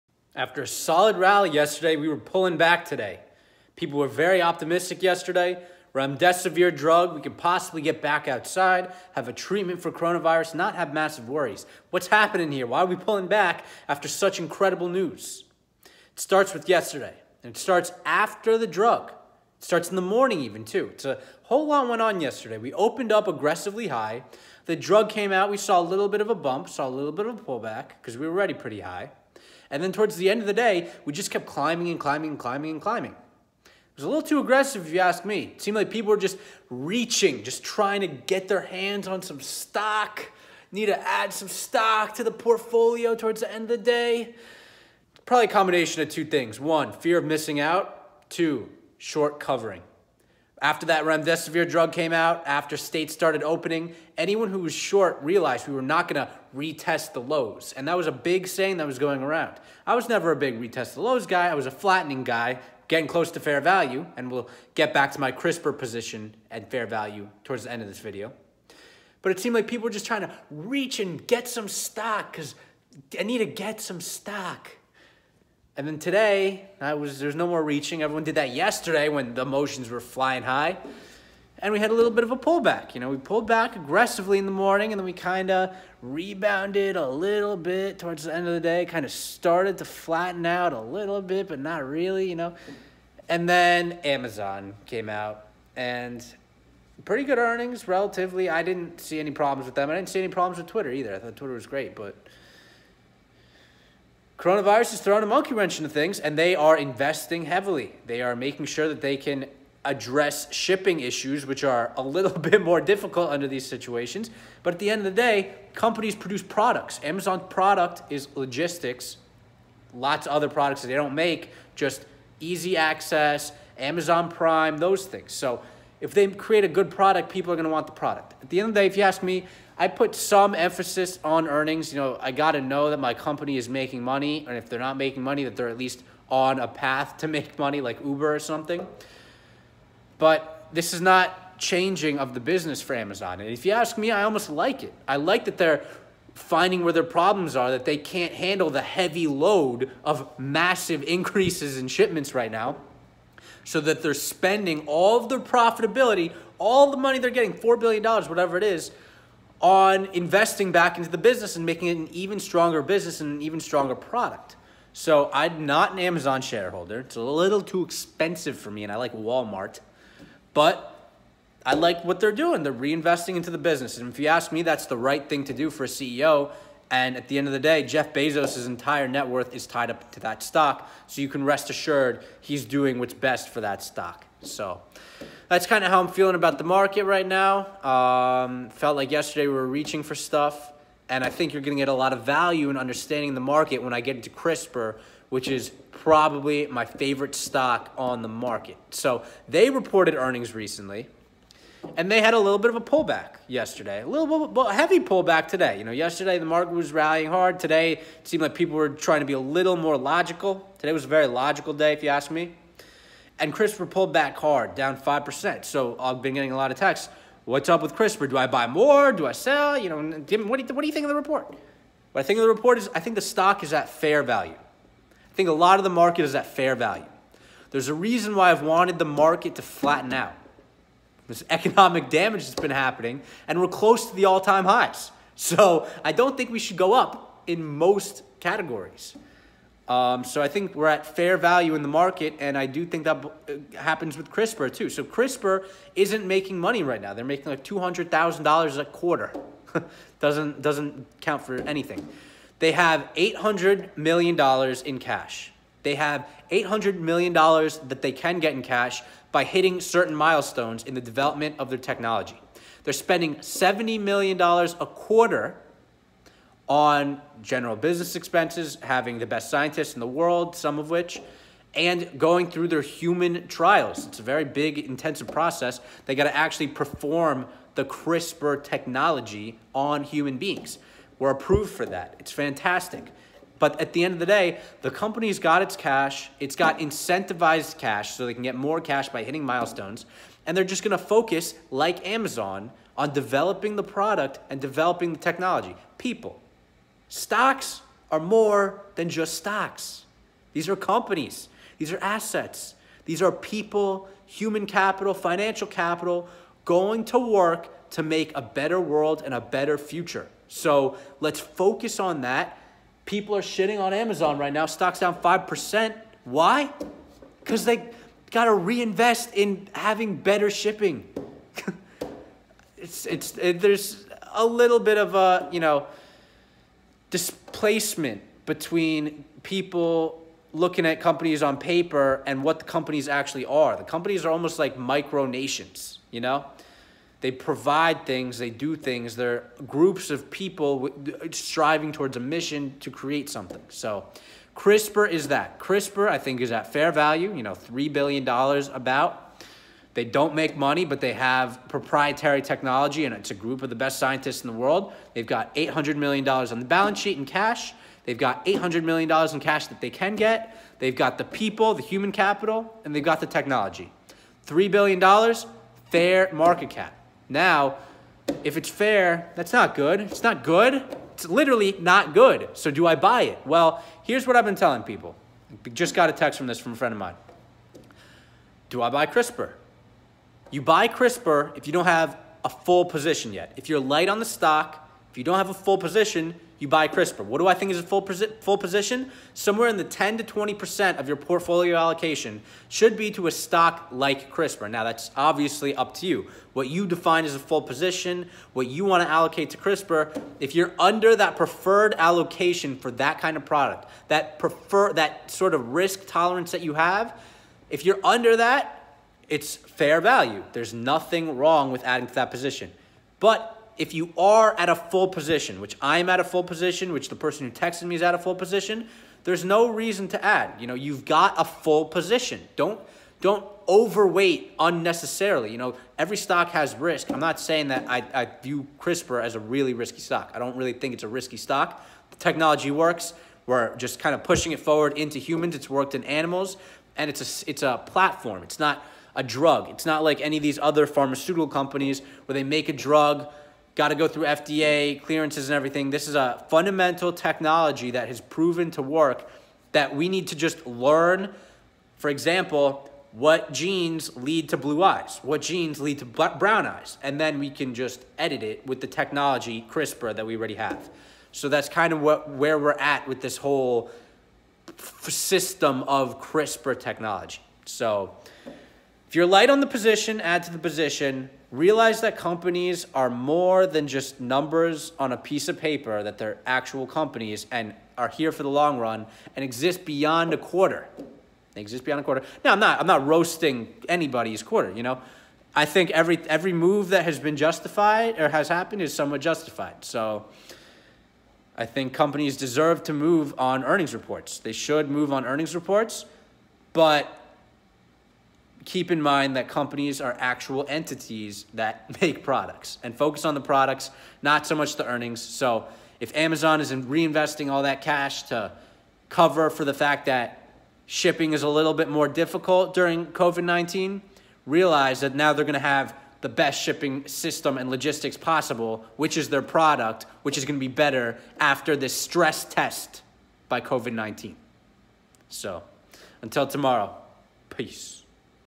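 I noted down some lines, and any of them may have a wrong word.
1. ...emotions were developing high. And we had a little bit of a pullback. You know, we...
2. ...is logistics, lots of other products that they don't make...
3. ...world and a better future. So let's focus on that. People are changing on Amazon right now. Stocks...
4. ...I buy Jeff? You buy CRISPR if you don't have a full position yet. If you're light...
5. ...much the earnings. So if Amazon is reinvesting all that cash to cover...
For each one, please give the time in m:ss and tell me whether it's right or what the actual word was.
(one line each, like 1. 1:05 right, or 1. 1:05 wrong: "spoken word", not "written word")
1. 1:19 wrong: "flying", not "developing"
2. 1:58 right
3. 5:08 wrong: "shitting", not "changing"
4. 6:18 wrong: "CRISPR", not "Jeff"
5. 8:24 right.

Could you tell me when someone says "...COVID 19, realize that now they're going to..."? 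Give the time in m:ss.
8:33.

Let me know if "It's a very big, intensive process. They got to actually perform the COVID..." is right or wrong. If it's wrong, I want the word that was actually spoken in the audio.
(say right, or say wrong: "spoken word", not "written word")
wrong: "CRISPR", not "COVID".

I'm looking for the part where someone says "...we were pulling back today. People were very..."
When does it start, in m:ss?
0:01.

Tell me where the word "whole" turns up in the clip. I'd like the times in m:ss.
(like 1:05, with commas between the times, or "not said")
0:21, 7:43.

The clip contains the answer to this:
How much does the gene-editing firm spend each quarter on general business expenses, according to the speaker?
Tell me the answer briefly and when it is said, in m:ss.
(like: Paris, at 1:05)
$70 million, at 4:23.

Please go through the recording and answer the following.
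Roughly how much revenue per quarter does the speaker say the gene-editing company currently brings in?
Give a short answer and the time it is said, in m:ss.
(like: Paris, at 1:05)
$200,000, at 4:07.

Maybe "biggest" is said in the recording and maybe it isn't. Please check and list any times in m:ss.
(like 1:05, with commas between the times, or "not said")
not said.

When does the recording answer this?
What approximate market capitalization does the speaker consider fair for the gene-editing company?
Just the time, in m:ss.
5:47.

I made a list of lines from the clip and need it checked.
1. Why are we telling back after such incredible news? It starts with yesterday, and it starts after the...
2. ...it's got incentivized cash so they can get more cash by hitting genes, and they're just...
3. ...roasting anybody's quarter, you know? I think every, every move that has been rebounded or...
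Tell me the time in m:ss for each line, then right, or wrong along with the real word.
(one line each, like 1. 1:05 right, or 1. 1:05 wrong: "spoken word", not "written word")
1. 0:12 wrong: "pulling", not "telling"
2. 4:46 wrong: "milestones", not "genes"
3. 8:03 wrong: "justified", not "rebounded".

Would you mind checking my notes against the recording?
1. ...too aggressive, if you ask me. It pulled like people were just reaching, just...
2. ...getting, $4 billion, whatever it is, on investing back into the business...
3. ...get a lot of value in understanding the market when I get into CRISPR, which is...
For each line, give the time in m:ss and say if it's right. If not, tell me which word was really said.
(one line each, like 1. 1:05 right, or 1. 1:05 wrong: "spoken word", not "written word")
1. 0:34 wrong: "seemed", not "pulled"
2. 2:37 right
3. 3:11 right.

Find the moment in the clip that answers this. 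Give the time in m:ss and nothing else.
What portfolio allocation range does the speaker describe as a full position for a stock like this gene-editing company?
6:29.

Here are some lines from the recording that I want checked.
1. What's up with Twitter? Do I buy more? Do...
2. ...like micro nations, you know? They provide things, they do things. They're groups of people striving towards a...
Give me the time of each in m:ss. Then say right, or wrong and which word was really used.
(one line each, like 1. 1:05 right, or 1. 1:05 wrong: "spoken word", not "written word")
1. 3:37 wrong: "CRISPR", not "Twitter"
2. 5:34 right.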